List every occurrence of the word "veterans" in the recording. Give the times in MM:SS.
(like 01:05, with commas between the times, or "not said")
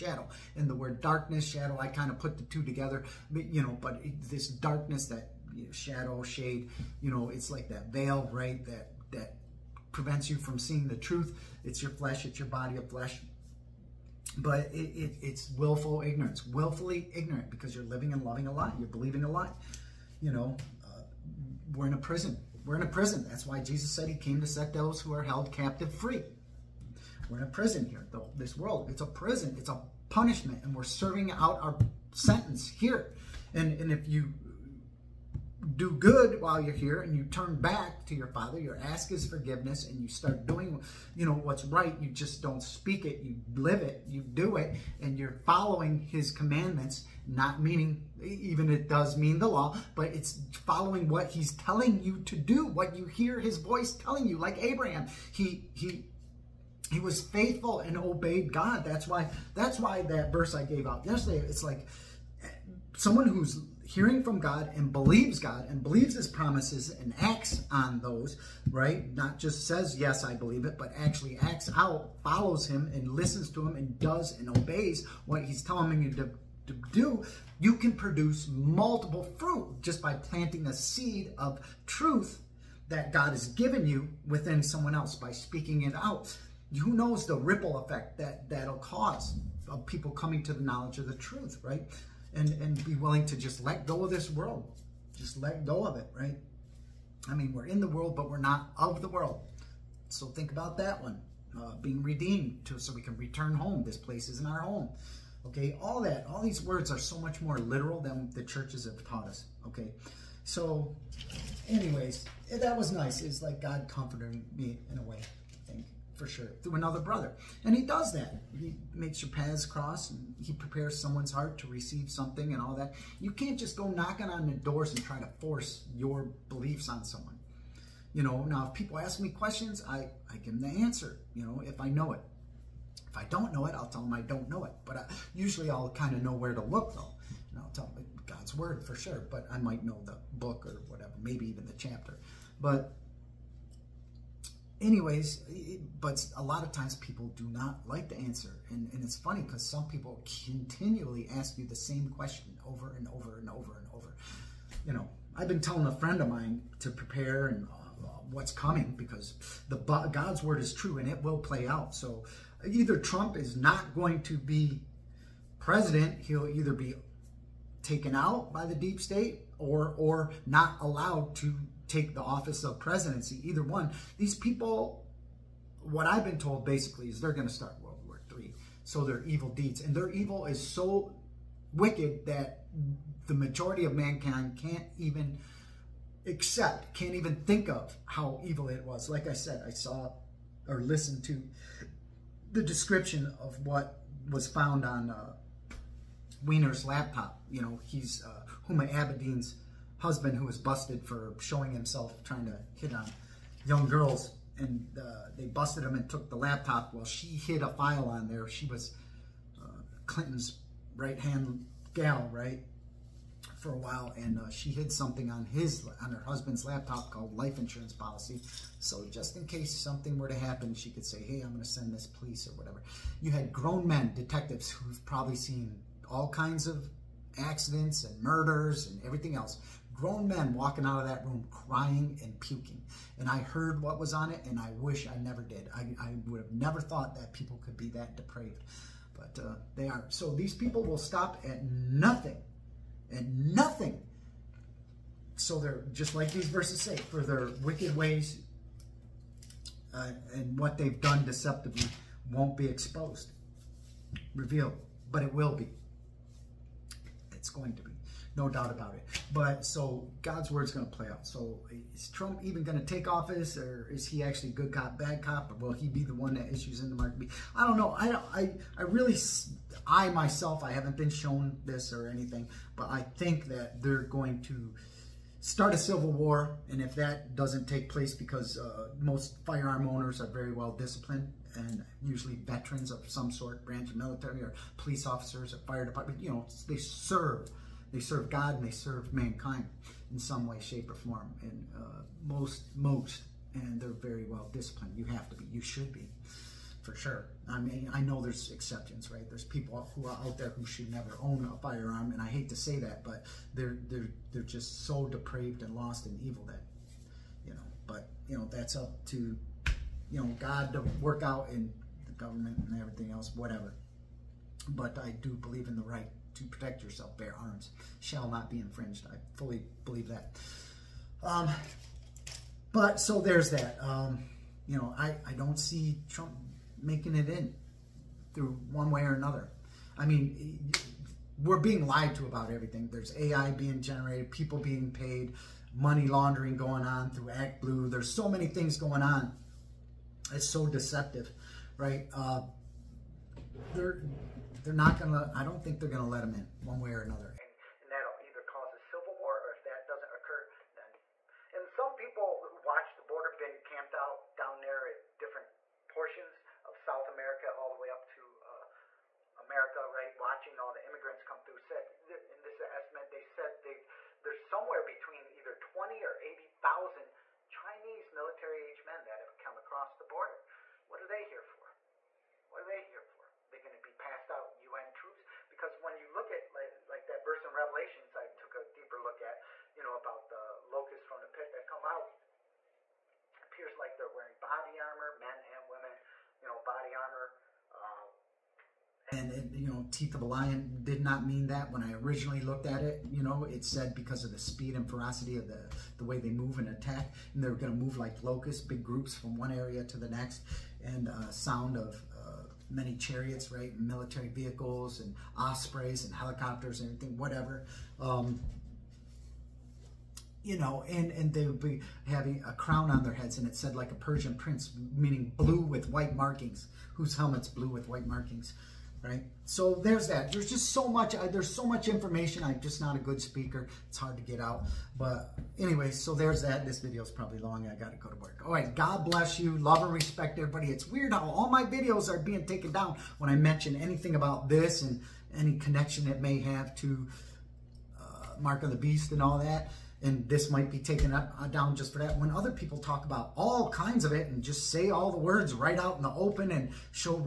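04:42.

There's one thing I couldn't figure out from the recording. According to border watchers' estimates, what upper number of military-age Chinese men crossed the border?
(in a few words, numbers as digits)
80,000.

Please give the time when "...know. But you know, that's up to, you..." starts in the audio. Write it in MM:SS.
05:07.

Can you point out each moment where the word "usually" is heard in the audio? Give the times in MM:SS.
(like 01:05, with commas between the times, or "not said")
02:15, 04:42.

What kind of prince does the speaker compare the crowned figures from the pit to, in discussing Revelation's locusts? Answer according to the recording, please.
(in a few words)
Persian prince.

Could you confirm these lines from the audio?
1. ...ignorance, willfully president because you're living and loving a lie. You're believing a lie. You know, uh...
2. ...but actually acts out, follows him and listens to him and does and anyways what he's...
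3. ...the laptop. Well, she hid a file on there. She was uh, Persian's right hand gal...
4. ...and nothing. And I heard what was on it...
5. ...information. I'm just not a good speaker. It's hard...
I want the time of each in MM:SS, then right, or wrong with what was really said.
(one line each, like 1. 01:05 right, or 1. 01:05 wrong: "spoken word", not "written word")
1. 00:16 wrong: "ignorant", not "president"
2. 01:10 wrong: "obeys", not "anyways"
3. 03:26 wrong: "Clinton", not "Persian"
4. 03:52 wrong: "puking", not "nothing"
5. 07:01 right.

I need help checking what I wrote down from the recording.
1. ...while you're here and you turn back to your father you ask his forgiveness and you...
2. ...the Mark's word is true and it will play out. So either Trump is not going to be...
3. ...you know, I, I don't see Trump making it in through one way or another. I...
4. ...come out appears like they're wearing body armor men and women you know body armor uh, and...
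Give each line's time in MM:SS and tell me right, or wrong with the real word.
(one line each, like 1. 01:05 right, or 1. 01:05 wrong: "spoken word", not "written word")
1. 00:36 right
2. 02:39 wrong: "God", not "Mark"
3. 05:24 right
4. 06:21 right.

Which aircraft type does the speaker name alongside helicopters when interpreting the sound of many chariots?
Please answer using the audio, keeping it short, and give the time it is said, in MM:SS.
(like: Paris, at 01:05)
ospreys, at 06:45.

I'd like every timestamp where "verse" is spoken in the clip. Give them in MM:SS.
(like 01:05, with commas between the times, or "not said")
01:00, 04:06, 06:17.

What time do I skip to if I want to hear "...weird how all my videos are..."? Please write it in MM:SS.
07:10.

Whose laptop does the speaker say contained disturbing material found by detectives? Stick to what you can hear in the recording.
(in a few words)
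Weiner's.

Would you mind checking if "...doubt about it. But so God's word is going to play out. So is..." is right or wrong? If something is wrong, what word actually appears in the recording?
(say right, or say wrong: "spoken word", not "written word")
right.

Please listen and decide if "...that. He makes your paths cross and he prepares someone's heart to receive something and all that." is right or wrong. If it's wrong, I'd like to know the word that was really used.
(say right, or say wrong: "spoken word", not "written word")
right.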